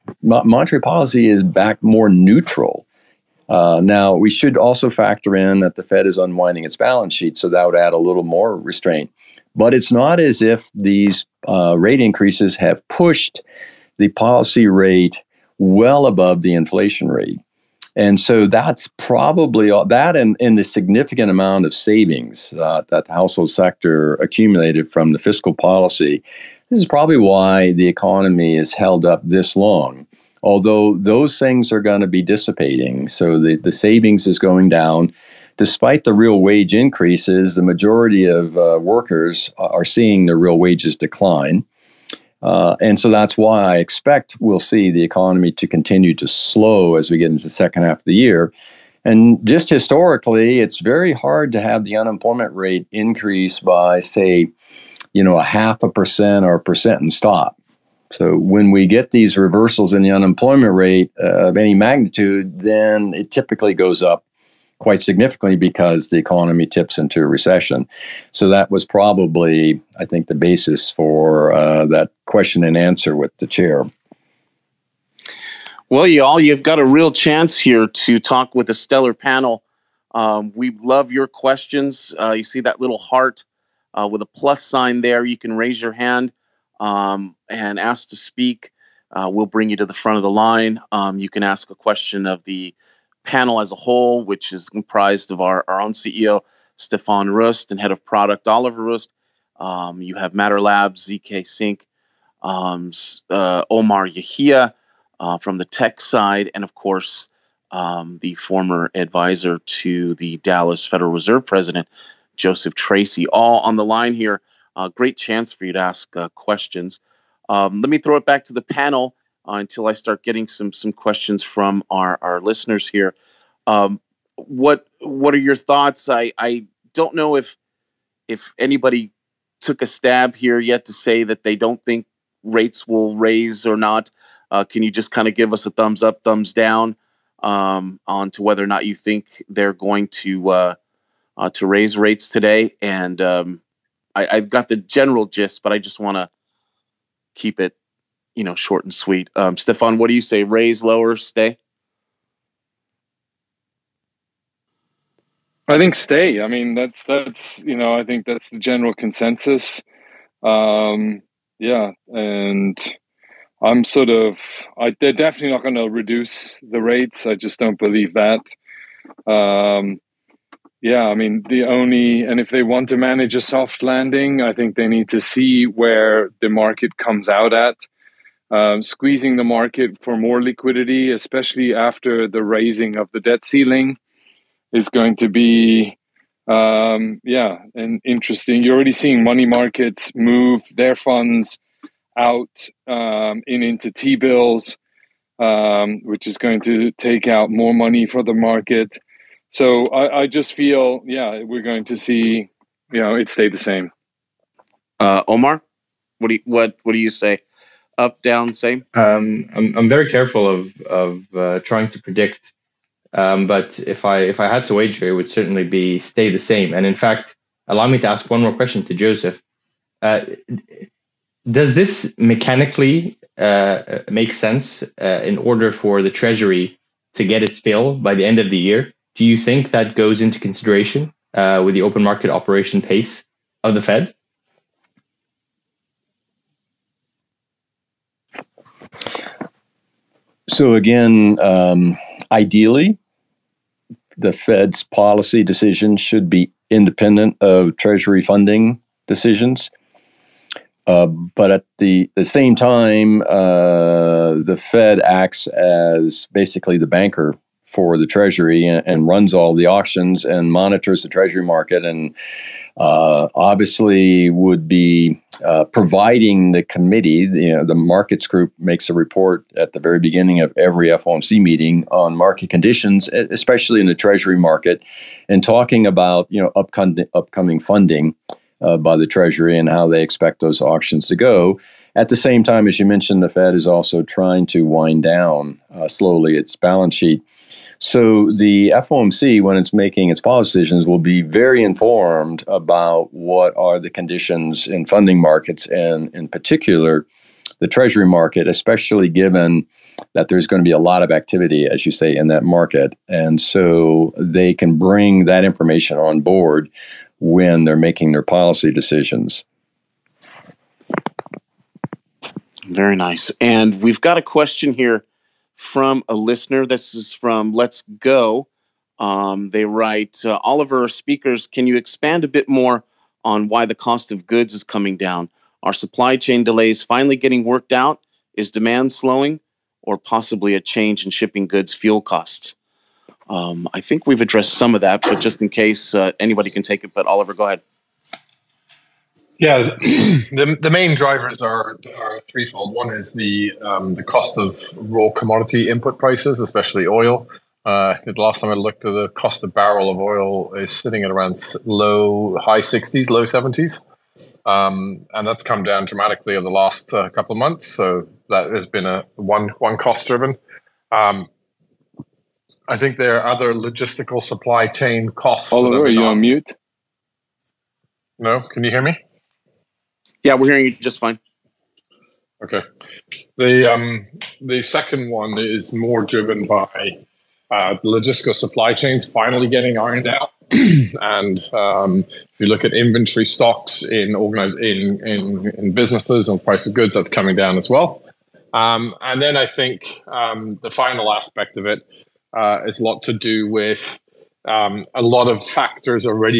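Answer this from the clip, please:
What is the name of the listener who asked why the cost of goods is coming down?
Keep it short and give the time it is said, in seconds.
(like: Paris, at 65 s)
Let's Go, at 317 s.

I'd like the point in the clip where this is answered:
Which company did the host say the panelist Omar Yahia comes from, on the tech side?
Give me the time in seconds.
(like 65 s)
100 s.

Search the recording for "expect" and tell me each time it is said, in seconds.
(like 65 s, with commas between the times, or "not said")
43 s, 280 s.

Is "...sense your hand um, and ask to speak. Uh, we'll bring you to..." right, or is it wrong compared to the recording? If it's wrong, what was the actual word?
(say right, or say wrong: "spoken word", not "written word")
wrong: "raise", not "sense".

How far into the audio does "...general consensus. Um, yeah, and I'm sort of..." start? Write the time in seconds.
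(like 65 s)
158 s.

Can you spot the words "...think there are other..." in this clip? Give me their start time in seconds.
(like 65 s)
362 s.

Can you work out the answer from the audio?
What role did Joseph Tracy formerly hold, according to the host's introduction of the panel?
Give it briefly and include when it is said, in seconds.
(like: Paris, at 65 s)
Advisor to the Dallas Federal Reserve President, at 108 s.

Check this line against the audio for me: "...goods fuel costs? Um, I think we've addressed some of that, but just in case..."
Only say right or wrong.
right.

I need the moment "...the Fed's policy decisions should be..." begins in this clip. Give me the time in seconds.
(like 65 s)
244 s.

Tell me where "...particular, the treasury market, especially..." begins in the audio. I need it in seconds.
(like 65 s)
296 s.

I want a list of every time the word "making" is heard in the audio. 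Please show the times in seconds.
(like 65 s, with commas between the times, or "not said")
289 s, 307 s.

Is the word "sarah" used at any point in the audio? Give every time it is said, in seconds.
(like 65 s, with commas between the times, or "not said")
not said.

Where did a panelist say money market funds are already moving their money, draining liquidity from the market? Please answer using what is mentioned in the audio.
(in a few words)
T bills.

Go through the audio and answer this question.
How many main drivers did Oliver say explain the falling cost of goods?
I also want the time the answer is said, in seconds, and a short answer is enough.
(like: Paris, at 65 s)
3, at 342 s.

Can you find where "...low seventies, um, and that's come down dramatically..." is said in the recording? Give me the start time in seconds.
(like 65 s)
353 s.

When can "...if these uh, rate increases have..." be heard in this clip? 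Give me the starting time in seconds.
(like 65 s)
10 s.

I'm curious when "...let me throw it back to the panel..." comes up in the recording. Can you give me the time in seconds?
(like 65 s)
117 s.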